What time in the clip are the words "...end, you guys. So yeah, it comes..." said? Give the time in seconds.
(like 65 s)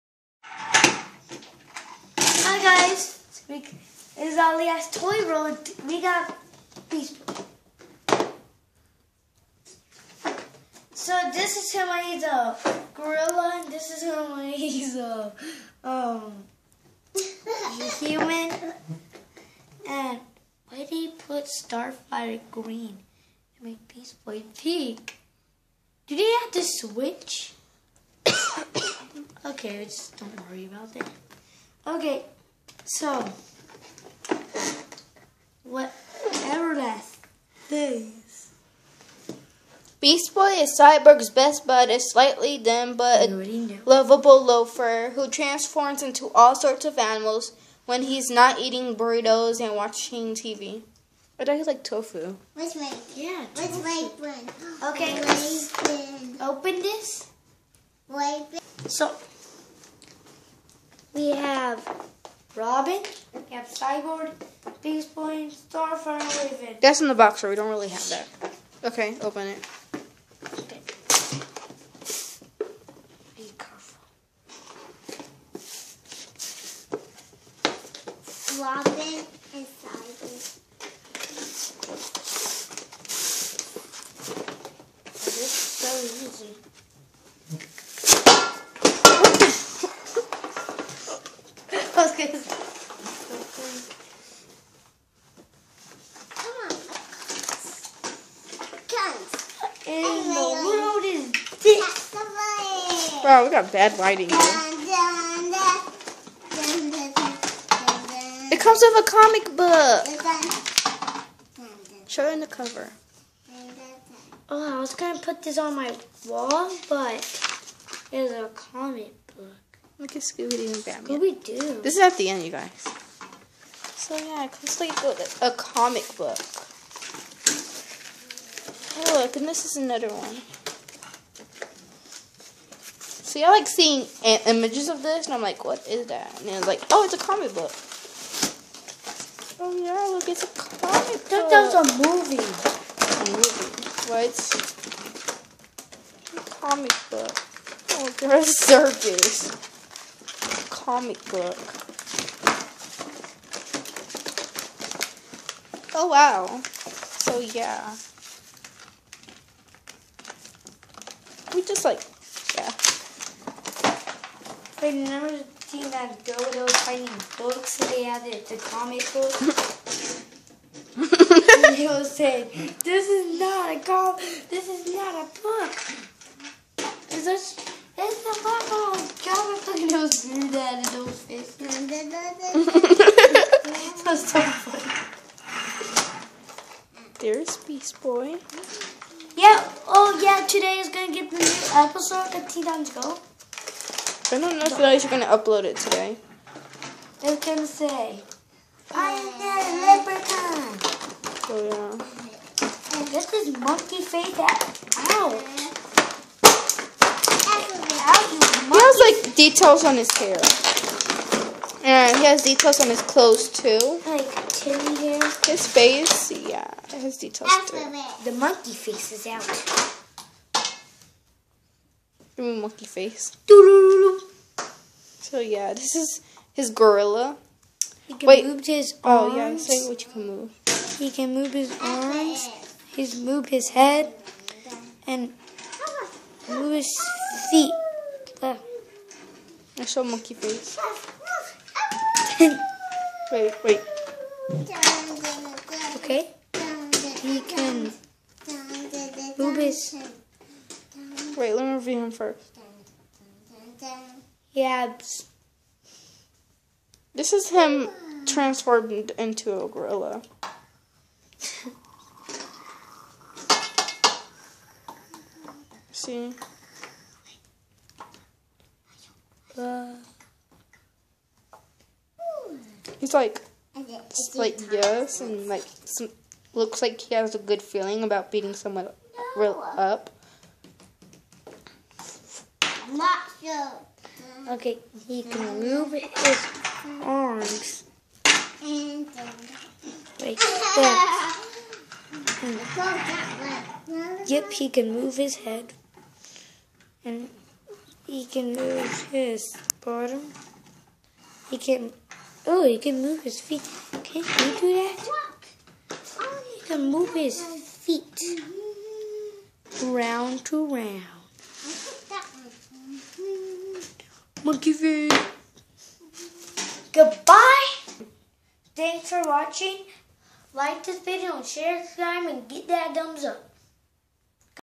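122 s.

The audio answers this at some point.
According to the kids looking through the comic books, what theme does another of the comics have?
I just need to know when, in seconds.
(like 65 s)
148 s.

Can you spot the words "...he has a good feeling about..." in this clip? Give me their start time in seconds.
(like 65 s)
277 s.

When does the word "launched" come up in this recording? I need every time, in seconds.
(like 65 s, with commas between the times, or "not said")
not said.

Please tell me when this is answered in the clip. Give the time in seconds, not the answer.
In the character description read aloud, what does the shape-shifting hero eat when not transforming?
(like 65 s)
48 s.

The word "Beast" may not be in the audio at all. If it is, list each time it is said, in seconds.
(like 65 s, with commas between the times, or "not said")
23 s, 39 s, 64 s, 187 s.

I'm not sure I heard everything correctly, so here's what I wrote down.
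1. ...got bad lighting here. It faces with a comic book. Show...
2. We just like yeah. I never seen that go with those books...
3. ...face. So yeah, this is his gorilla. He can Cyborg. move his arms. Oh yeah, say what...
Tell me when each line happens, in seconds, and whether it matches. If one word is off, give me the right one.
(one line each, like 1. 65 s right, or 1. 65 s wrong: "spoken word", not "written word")
1. 103 s wrong: "comes", not "faces"
2. 161 s right
3. 222 s wrong: "Wait", not "Cyborg".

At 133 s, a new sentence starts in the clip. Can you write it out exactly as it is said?
See, I like seeing images of this, and I'm like, what is that?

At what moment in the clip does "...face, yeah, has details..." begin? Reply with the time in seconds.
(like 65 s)
215 s.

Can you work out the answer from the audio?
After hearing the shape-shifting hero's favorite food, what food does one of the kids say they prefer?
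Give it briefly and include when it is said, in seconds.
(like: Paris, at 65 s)
Tofu, at 51 s.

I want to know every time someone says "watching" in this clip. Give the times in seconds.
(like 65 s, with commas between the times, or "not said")
49 s, 319 s.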